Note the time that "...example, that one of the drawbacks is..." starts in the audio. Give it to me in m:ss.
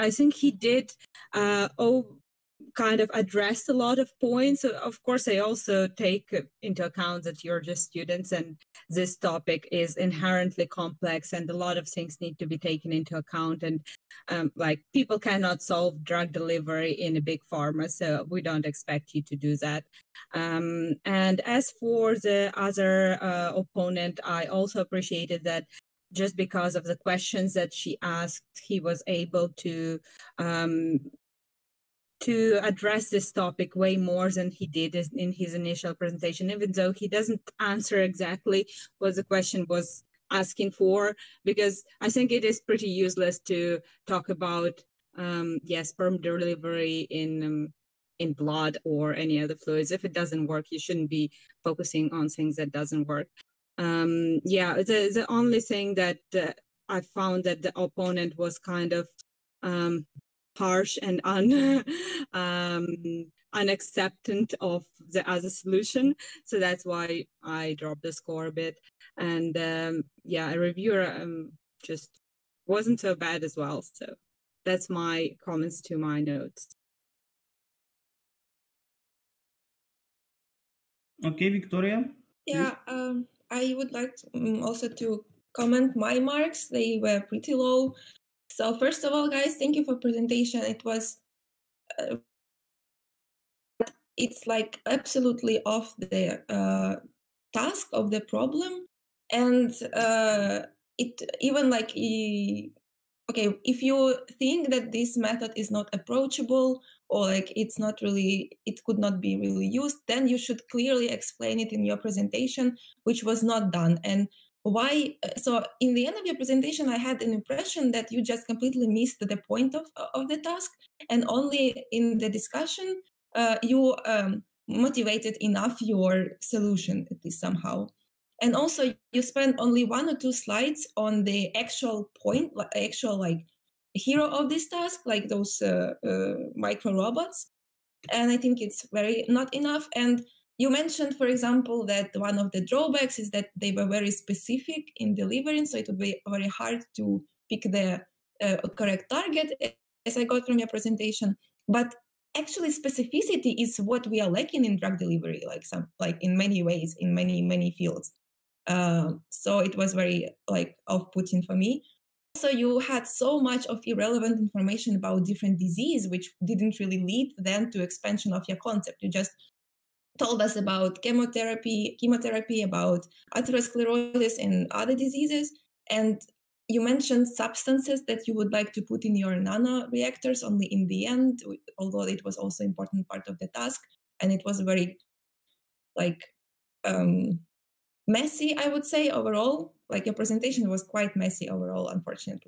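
2:21.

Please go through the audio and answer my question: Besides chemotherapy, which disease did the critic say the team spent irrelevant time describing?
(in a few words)
Atherosclerosis.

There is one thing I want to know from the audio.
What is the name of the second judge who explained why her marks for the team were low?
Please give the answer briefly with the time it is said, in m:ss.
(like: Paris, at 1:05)
Victoria, at 1:21.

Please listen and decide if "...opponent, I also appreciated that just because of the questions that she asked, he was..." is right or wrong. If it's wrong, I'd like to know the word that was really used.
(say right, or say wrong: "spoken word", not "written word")
right.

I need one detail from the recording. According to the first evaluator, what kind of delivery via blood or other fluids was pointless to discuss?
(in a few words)
Sperm delivery.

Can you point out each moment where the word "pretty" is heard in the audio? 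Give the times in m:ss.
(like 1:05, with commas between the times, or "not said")
0:42, 1:27.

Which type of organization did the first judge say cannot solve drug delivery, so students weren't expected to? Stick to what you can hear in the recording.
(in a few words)
Big pharma.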